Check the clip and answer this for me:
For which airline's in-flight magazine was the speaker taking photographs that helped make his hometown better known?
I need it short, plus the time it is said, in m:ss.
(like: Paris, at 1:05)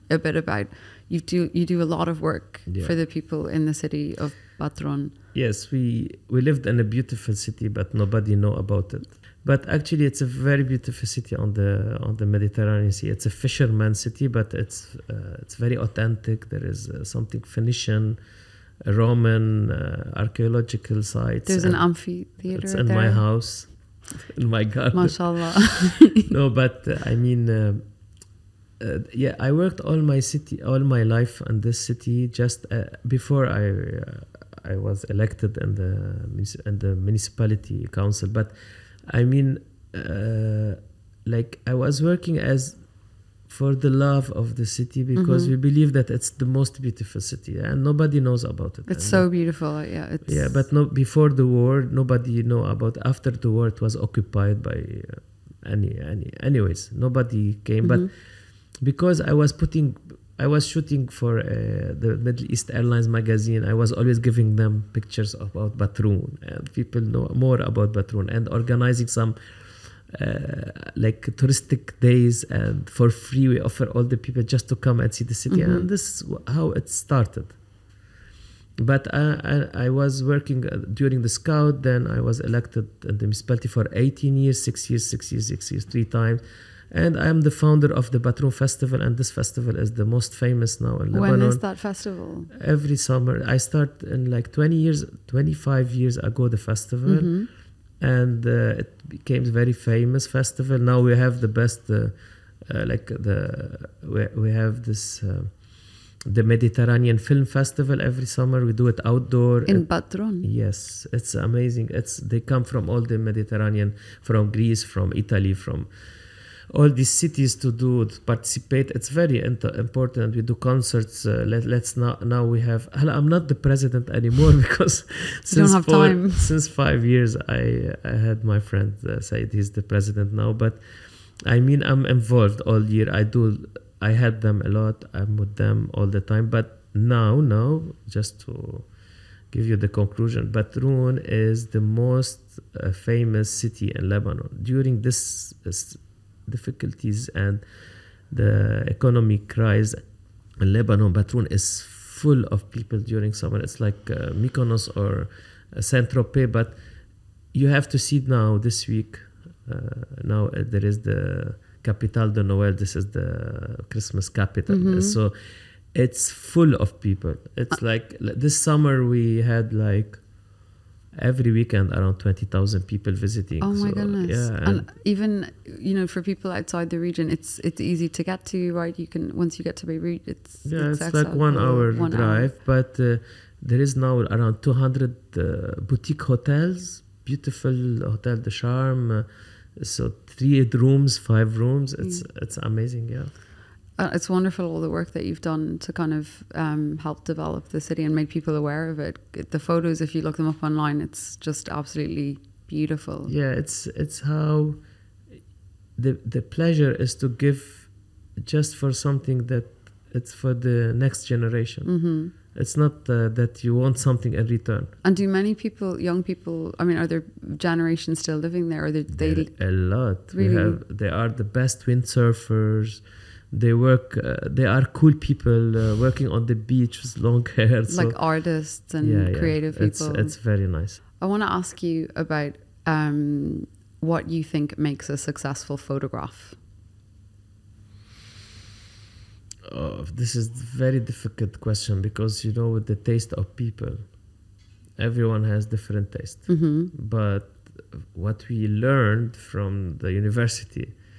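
Middle East Airlines, at 1:02.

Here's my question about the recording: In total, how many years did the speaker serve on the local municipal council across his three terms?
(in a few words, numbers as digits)
18.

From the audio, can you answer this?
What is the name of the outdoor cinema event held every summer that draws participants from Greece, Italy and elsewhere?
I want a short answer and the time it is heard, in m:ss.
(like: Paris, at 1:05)
Mediterranean Film Festival, at 1:46.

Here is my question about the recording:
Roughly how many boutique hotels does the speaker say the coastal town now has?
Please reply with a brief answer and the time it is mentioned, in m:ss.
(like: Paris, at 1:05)
200, at 3:04.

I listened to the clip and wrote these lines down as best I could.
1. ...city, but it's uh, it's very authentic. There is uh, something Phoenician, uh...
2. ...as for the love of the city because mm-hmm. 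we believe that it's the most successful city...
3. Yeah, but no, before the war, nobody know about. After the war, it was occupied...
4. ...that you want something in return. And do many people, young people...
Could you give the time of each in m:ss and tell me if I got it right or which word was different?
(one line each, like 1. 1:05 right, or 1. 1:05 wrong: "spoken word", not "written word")
1. 0:13 right
2. 0:42 wrong: "beautiful", not "successful"
3. 0:50 right
4. 3:33 right.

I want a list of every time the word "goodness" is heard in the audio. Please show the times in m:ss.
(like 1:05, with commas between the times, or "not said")
2:53.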